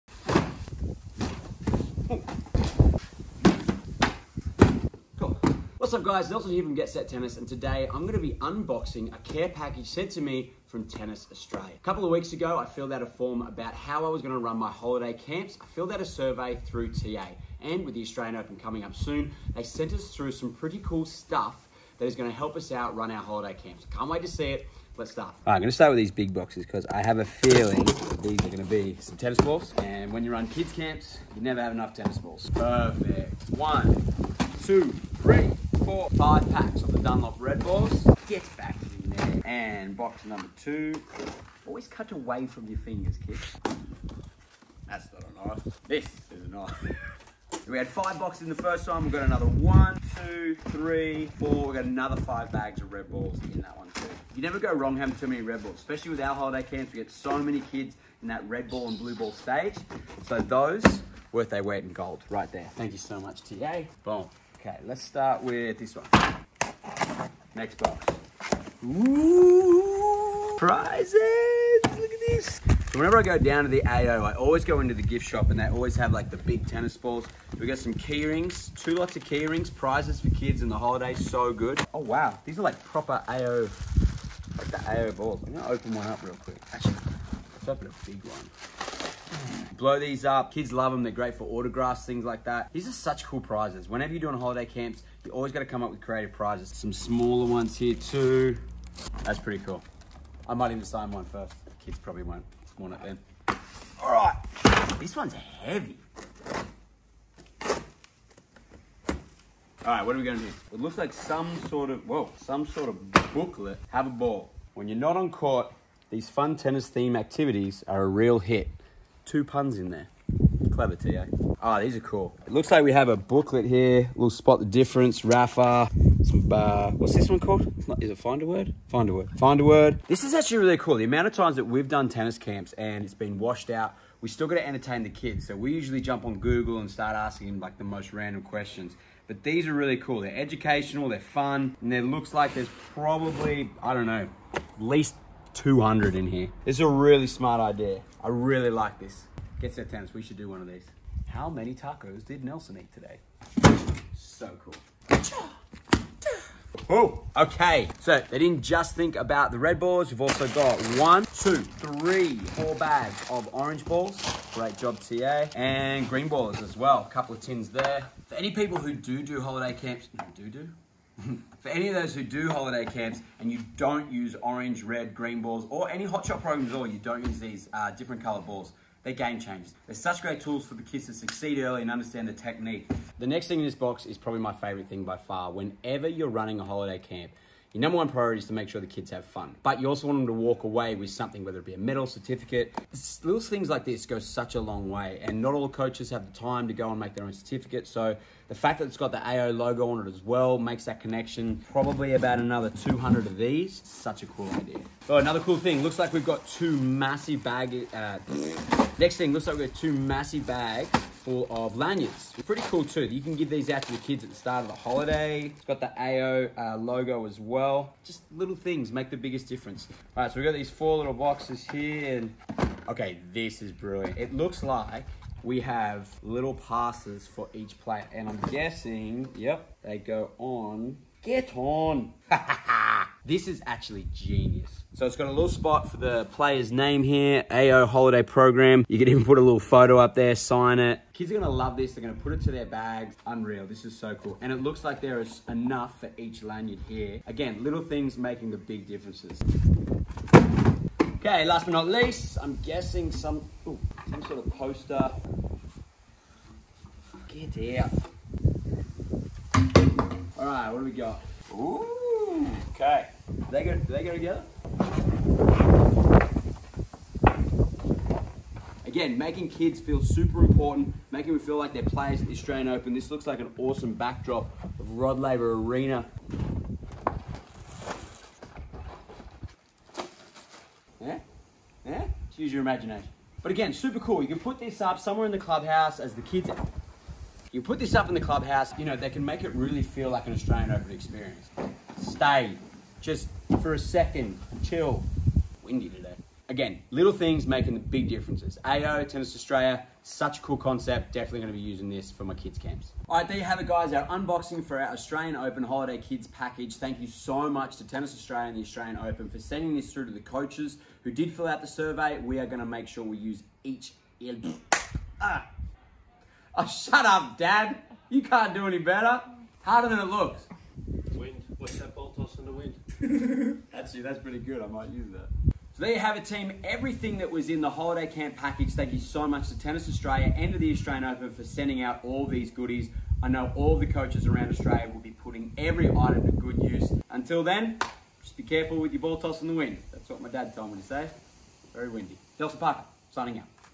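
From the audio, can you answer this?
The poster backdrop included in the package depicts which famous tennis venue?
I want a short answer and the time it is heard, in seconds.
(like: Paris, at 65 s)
Rod Laver Arena, at 274 s.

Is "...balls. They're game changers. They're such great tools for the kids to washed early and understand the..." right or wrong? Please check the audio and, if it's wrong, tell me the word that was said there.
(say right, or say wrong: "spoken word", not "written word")
wrong: "succeed", not "washed".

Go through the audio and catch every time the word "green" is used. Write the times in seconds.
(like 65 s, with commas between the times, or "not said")
166 s, 175 s.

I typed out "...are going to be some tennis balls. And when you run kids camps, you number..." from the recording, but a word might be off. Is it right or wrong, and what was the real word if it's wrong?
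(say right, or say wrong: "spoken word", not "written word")
wrong: "never", not "number".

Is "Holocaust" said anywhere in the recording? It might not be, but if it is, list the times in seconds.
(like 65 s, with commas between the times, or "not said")
not said.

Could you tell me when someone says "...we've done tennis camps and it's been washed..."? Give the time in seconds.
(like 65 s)
131 s.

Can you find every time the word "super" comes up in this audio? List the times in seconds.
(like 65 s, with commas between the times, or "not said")
270 s, 283 s.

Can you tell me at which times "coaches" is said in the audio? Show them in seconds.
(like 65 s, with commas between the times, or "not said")
195 s, 310 s, 333 s.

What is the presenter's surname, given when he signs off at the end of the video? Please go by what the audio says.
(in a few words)
Parker.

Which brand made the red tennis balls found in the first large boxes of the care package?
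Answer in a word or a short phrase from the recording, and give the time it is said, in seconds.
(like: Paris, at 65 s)
Dunlop, at 36 s.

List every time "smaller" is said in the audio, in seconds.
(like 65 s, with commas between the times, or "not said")
96 s.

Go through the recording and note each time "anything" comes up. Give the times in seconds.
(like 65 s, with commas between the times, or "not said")
not said.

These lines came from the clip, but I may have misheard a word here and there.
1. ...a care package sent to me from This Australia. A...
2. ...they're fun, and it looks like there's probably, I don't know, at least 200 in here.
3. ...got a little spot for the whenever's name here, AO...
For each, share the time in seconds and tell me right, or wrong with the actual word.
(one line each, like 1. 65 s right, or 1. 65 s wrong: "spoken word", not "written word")
1. 9 s wrong: "Tennis", not "This"
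2. 141 s right
3. 235 s wrong: "player", not "whenever".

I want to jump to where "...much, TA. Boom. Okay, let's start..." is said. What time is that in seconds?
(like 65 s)
63 s.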